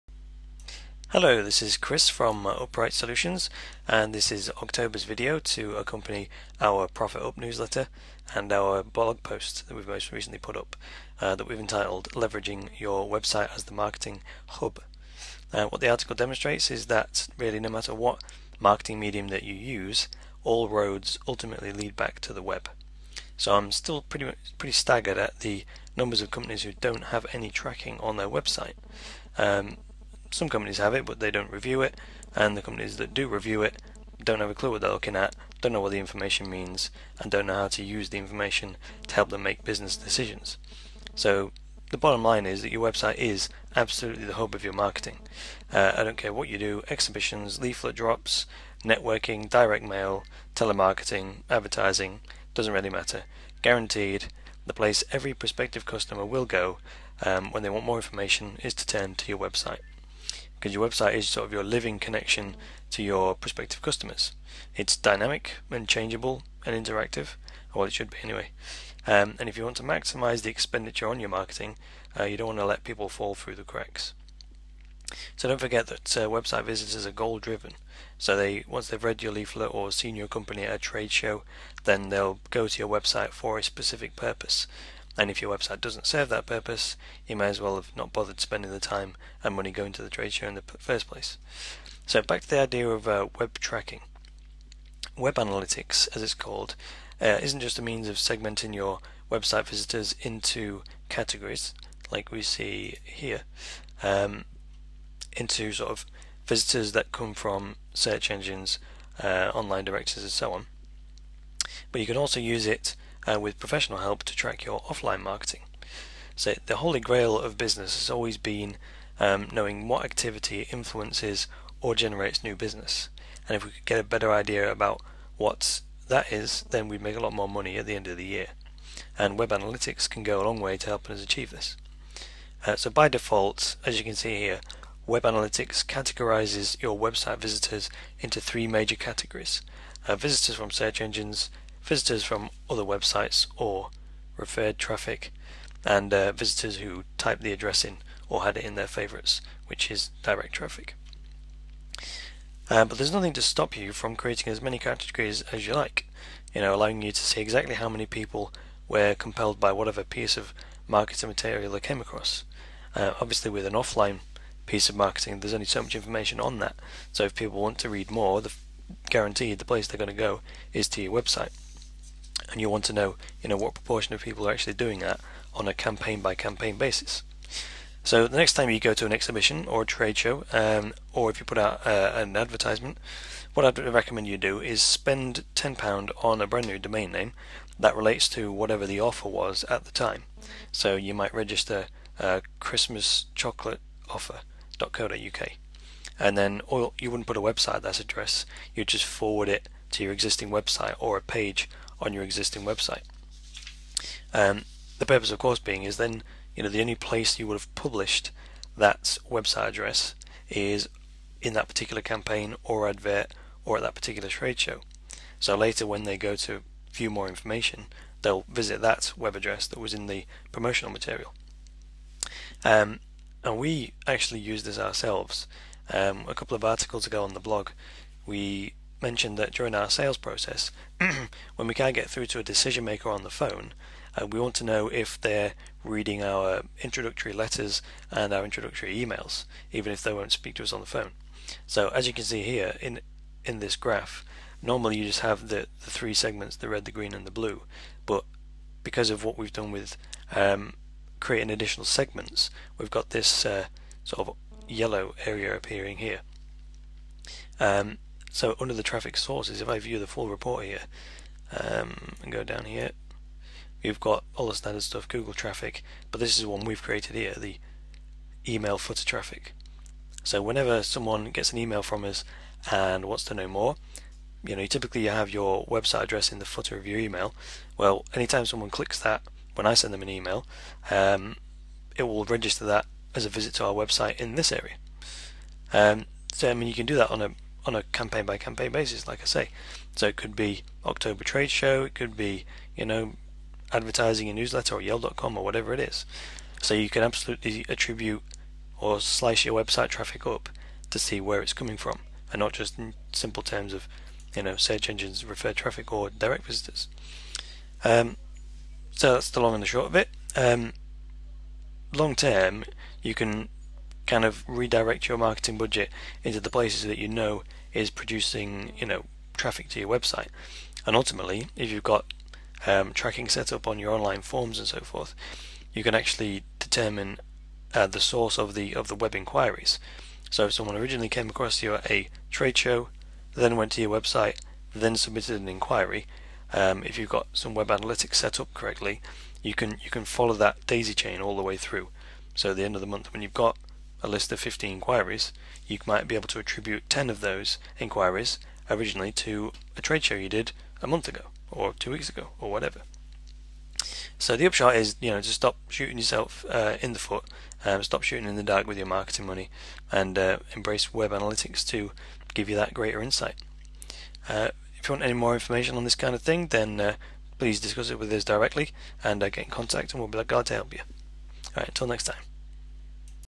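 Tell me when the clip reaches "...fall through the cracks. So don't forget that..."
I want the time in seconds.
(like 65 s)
73 s.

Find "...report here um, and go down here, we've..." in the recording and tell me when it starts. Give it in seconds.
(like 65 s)
260 s.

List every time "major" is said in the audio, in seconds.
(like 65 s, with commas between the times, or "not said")
138 s.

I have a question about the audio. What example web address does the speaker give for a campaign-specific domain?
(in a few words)
christmaschocolateoffer.co.uk.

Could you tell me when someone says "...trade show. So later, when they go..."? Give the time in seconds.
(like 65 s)
214 s.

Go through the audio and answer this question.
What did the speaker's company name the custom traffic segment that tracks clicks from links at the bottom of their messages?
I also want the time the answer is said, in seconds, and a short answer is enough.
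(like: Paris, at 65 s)
email footer traffic, at 268 s.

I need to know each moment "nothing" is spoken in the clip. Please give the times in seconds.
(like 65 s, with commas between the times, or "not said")
153 s.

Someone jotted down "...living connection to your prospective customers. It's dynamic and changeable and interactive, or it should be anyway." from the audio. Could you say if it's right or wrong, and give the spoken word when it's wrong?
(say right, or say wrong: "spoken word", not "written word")
right.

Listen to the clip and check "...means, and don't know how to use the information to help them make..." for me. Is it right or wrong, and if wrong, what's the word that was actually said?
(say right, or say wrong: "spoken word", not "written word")
right.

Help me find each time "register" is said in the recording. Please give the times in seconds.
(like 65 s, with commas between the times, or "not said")
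191 s, 282 s.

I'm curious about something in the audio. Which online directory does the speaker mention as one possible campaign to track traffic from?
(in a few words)
Yell.com.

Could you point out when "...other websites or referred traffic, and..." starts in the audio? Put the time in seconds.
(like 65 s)
142 s.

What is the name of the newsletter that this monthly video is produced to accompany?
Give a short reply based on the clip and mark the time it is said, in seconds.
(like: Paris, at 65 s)
Profit Up, at 6 s.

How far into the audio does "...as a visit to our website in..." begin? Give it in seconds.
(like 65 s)
283 s.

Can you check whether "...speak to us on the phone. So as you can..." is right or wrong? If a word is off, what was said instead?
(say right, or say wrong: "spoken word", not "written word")
right.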